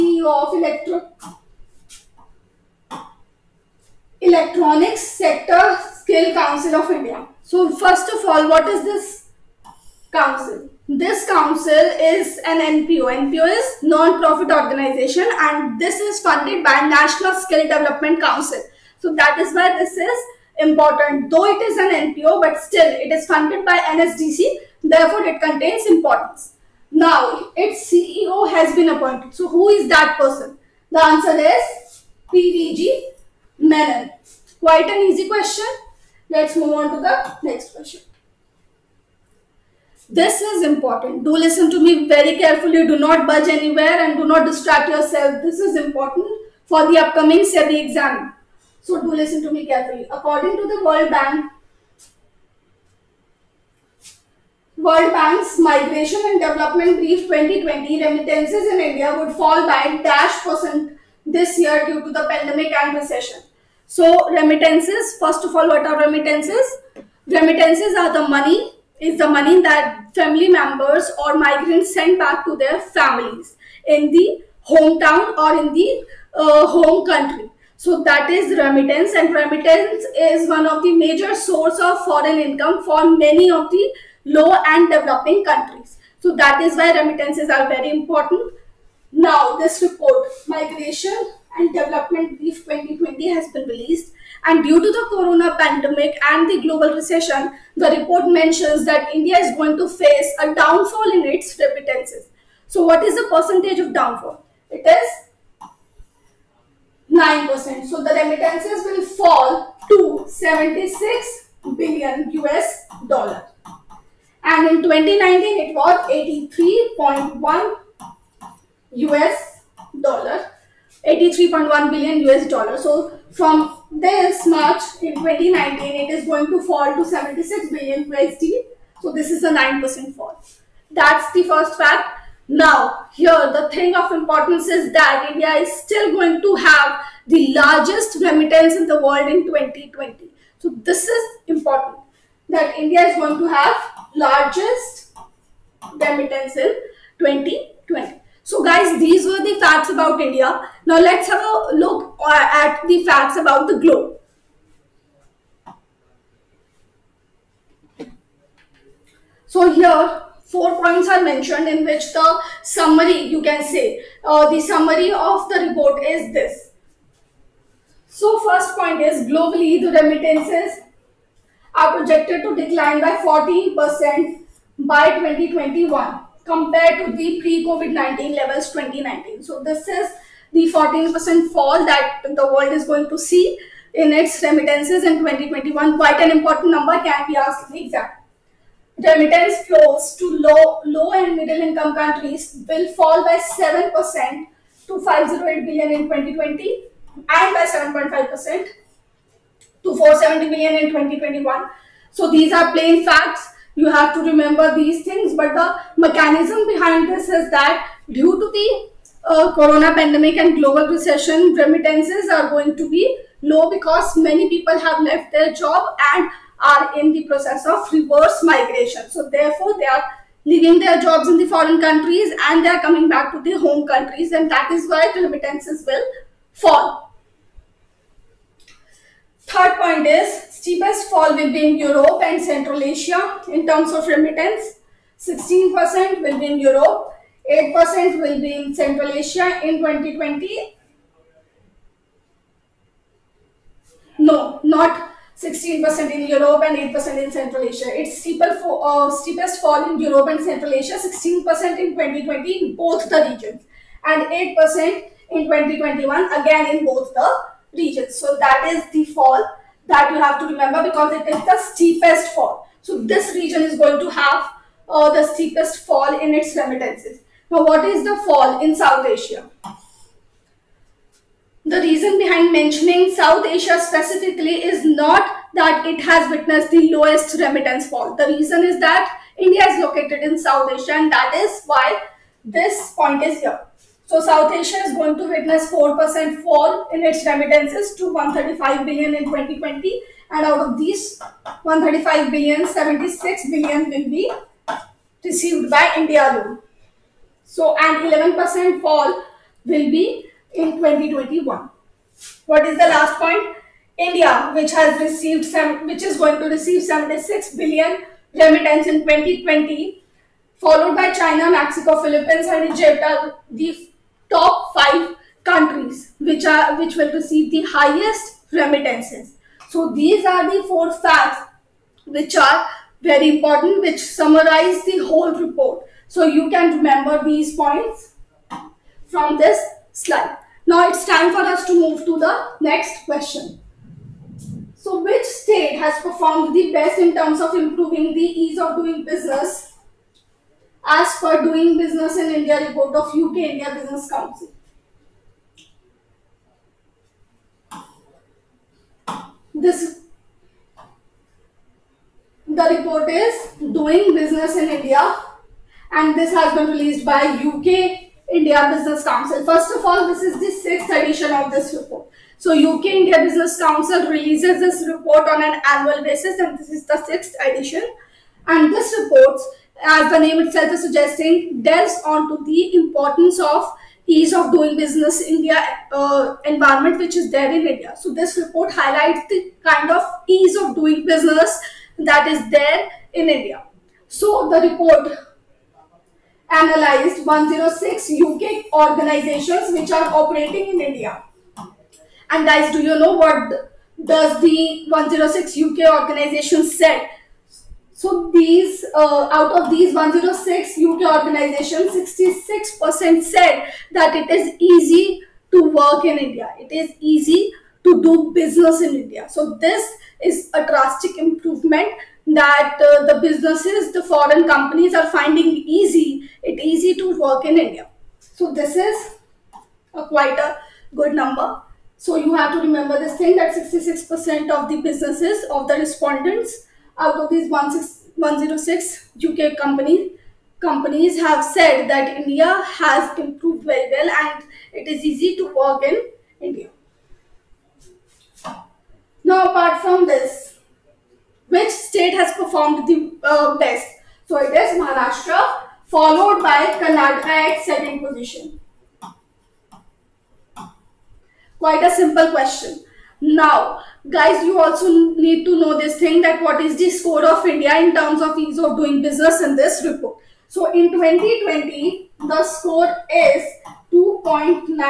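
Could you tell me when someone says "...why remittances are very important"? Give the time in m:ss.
1:26.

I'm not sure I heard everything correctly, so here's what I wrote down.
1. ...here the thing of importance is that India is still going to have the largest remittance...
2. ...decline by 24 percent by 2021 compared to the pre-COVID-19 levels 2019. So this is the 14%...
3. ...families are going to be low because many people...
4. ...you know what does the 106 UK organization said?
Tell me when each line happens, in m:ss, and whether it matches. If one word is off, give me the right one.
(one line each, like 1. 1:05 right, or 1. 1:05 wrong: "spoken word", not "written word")
1. 2:13 right
2. 2:52 wrong: "14", not "24"
3. 3:31 wrong: "remittances", not "families"
4. 6:32 right.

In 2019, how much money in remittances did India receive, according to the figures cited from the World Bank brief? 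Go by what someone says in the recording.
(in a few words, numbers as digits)
83.1 billion US dollars.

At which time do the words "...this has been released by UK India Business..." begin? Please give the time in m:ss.
5:56.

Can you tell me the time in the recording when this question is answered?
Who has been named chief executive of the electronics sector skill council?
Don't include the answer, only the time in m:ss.
0:32.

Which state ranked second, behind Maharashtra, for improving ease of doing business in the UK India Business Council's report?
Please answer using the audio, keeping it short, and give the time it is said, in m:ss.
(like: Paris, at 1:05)
Karnataka, at 7:26.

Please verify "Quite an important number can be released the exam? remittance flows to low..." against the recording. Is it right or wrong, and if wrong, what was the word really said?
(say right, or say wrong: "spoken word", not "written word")
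wrong: "asked", not "released".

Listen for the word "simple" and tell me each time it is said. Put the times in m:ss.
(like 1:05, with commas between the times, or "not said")
7:31.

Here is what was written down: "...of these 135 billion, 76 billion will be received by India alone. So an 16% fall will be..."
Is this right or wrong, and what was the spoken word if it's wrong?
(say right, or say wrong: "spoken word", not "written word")
wrong: "11", not "16".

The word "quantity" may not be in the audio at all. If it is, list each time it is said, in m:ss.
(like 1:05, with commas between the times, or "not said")
not said.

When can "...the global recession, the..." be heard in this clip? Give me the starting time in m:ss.
1:36.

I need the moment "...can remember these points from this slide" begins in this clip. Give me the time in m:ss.
5:26.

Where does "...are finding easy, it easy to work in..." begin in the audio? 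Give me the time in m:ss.
6:54.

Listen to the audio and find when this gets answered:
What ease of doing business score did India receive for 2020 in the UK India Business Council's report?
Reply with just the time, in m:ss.
7:43.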